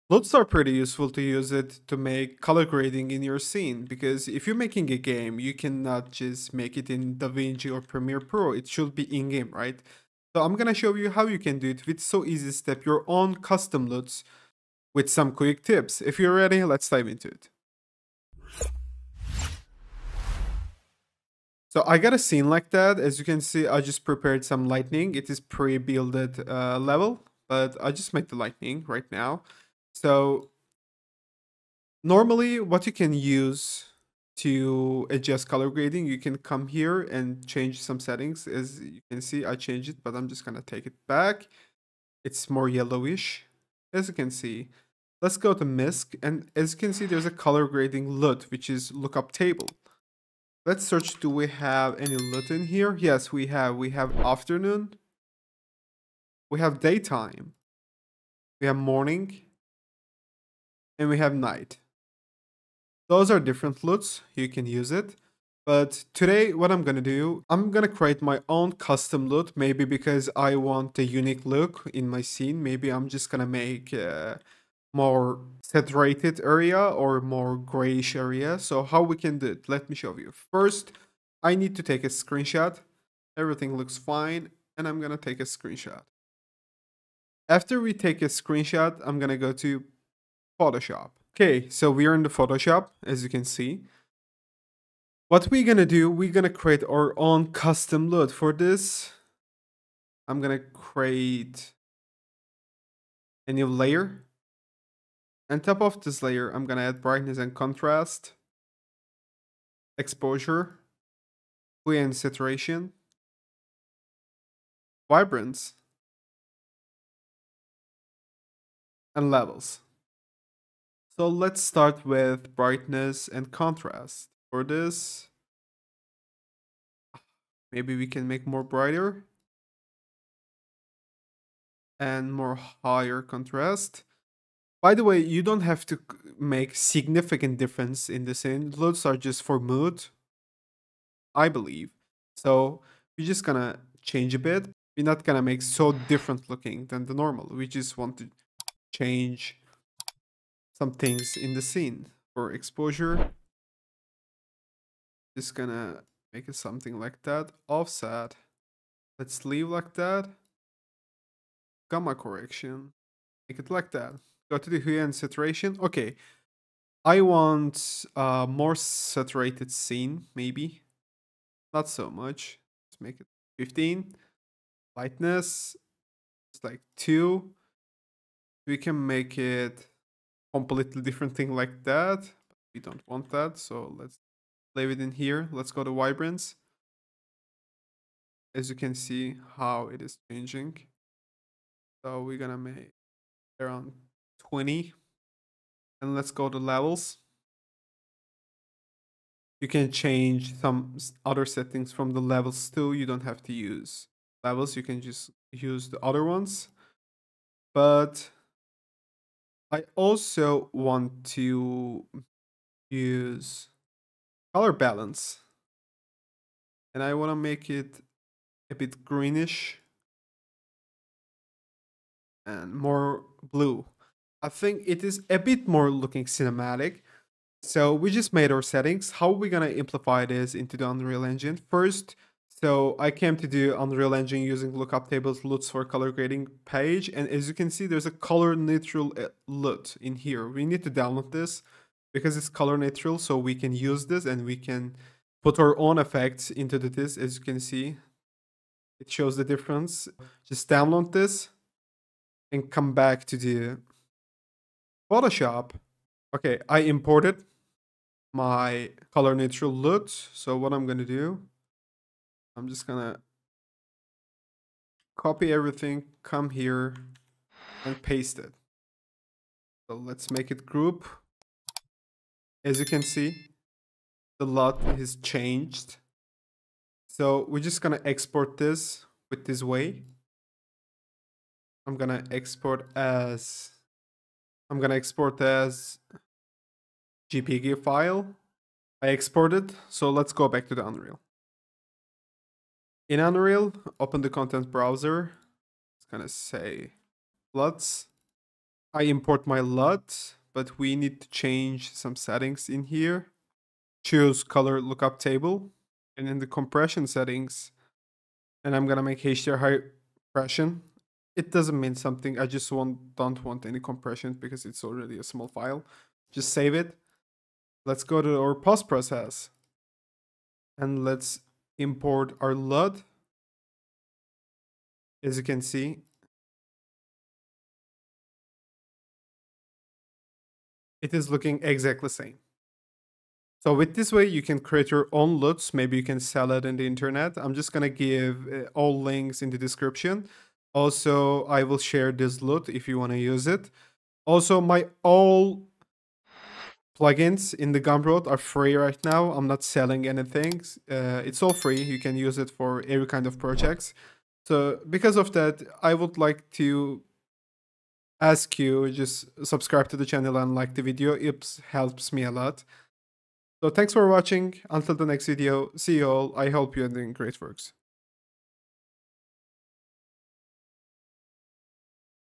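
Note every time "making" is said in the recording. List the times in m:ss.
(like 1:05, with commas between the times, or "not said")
0:04.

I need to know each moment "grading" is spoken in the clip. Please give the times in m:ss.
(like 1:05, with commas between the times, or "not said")
0:02, 0:35, 0:47, 3:56.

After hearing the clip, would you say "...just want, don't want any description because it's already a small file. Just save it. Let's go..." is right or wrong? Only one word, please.
wrong.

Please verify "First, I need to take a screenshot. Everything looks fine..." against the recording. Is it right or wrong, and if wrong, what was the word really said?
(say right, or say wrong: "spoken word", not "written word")
right.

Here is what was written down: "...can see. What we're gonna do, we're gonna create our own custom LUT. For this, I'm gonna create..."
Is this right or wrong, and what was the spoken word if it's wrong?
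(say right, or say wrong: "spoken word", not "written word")
right.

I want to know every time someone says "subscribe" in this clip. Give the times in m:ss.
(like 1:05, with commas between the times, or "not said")
5:59.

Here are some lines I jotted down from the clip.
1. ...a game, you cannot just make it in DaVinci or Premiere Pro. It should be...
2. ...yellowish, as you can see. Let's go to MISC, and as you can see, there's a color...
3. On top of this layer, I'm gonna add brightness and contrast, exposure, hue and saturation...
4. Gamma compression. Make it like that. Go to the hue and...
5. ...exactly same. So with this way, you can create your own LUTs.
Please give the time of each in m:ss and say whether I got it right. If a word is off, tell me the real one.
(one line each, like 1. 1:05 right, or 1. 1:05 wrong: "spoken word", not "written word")
1. 0:04 right
2. 0:42 right
3. 1:45 right
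4. 2:41 wrong: "correction", not "compression"
5. 5:31 right.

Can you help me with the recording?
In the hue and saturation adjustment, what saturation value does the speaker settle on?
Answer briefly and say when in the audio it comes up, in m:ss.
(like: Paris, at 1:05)
15, at 2:52.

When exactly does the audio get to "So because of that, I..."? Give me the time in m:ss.
5:54.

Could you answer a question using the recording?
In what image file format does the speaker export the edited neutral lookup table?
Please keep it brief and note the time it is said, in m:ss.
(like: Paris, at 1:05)
JPG, at 4:47.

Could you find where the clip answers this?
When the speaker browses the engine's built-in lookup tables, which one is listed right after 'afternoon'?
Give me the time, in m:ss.
0:56.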